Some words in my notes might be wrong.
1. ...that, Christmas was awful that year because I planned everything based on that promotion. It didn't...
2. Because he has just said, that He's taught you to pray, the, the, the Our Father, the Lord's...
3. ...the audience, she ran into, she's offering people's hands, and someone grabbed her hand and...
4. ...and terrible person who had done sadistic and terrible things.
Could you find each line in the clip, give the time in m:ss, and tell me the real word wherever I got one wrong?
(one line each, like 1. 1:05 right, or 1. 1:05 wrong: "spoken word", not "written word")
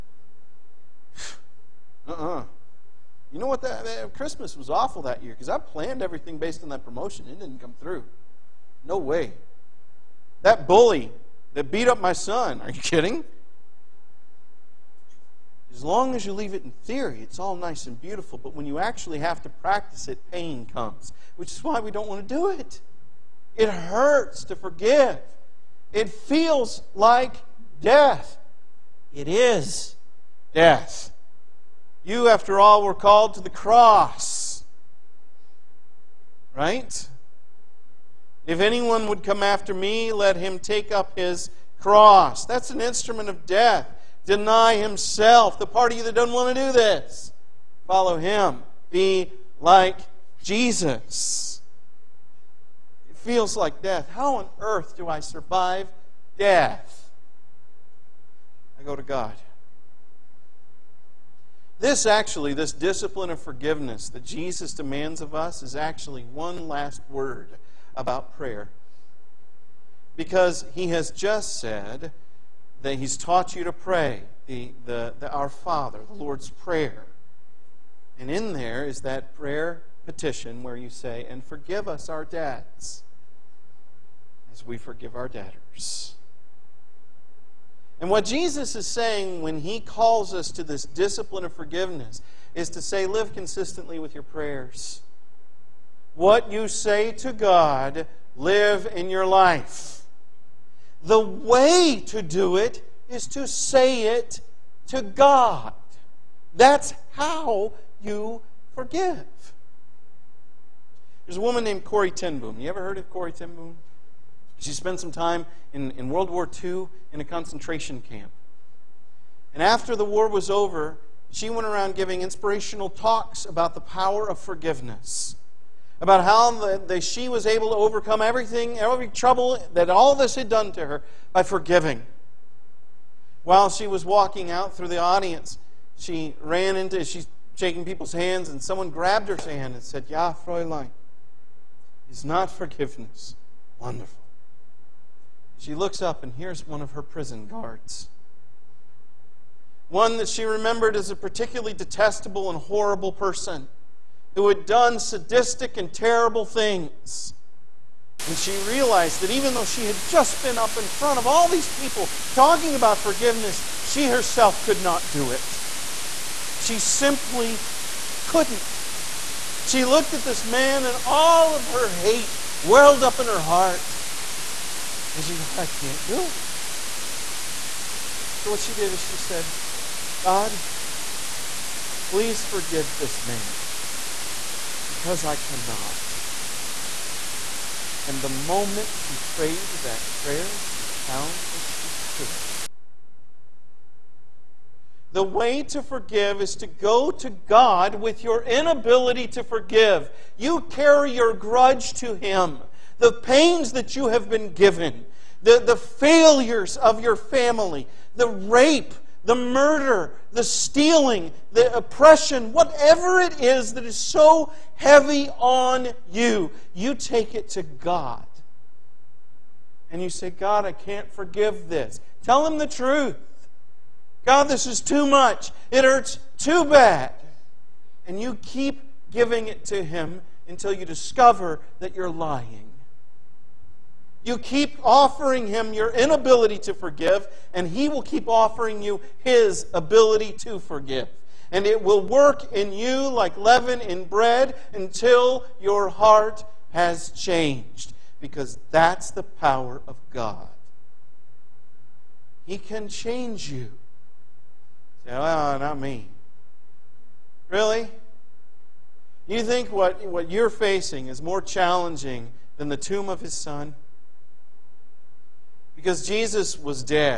1. 0:03 right
2. 1:10 right
3. 2:14 wrong: "shaking", not "offering"
4. 2:32 wrong: "horrible", not "terrible".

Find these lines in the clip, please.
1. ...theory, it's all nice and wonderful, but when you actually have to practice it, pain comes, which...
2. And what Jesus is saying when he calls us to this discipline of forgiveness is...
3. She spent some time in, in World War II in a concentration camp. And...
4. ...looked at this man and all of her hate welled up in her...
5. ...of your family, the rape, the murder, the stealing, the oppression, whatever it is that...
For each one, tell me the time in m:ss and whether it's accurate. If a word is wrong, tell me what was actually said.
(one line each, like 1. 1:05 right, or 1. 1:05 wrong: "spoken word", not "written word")
1. 0:16 wrong: "beautiful", not "wonderful"
2. 1:27 right
3. 1:54 right
4. 2:49 right
5. 3:26 right.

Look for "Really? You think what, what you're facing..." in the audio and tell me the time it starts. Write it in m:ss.
4:17.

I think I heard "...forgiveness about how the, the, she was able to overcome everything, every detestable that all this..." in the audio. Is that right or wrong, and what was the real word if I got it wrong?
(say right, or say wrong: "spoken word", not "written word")
wrong: "trouble", not "detestable".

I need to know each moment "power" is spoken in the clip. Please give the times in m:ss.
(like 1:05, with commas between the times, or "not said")
2:03, 4:09.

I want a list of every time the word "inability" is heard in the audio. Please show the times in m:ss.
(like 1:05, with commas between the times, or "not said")
3:18, 3:55.